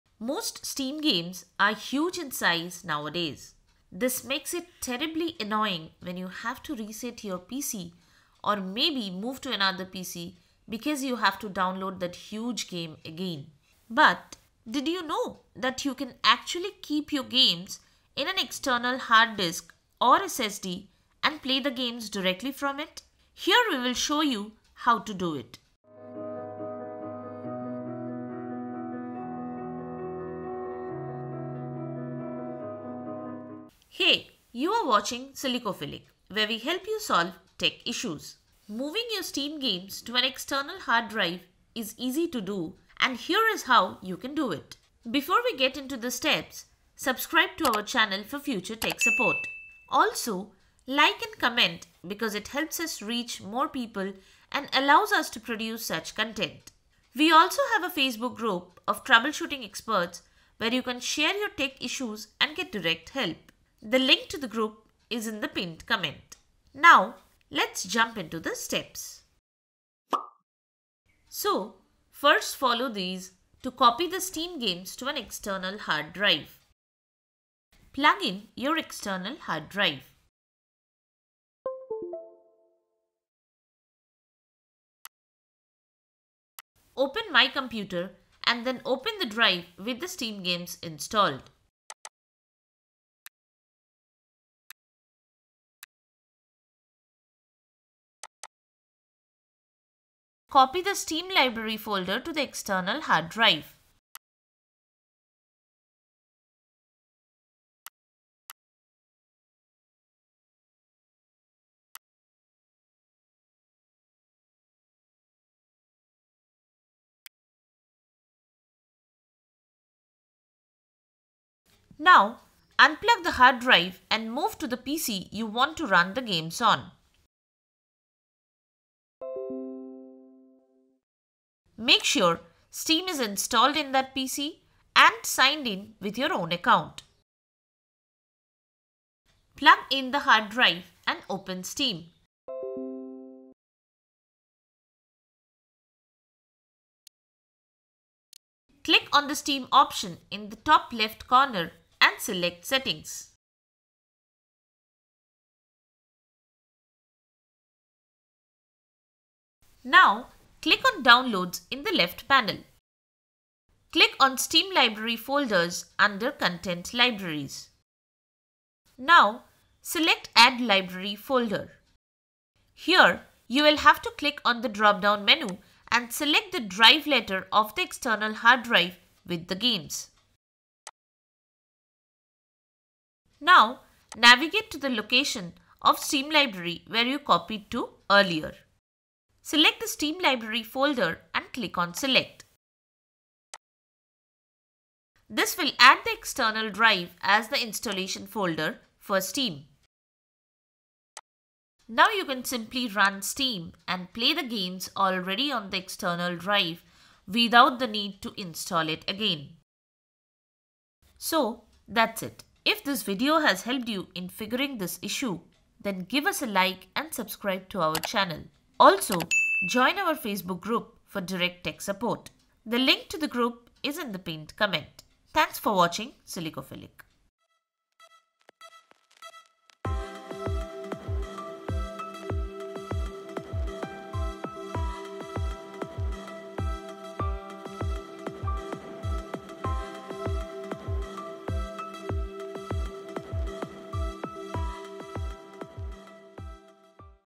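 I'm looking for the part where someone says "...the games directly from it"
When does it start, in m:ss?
0:21.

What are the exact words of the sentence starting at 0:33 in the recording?
Hey, you are watching Silicophilic, where we help you solve tech issues.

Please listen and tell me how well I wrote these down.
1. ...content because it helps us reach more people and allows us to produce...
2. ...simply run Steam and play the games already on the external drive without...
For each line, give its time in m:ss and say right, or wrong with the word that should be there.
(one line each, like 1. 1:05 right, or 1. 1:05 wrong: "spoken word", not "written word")
1. 0:51 wrong: "comment", not "content"
2. 3:22 right.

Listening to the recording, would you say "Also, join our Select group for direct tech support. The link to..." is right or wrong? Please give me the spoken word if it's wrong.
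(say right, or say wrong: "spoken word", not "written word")
wrong: "Facebook", not "Select".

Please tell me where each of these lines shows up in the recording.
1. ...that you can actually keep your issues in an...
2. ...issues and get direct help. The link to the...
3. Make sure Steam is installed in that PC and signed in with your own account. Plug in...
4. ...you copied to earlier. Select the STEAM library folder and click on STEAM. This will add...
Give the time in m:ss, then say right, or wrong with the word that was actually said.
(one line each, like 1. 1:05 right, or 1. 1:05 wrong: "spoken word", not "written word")
1. 0:15 wrong: "games", not "issues"
2. 1:01 right
3. 2:11 right
4. 3:07 wrong: "Select", not "STEAM".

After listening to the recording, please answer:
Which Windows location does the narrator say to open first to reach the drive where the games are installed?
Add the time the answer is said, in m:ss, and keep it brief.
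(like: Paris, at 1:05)
My Computer, at 1:27.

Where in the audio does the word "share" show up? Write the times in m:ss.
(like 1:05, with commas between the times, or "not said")
1:01.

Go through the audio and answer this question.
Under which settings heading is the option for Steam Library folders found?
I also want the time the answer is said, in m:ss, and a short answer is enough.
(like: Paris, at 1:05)
Content Libraries, at 2:46.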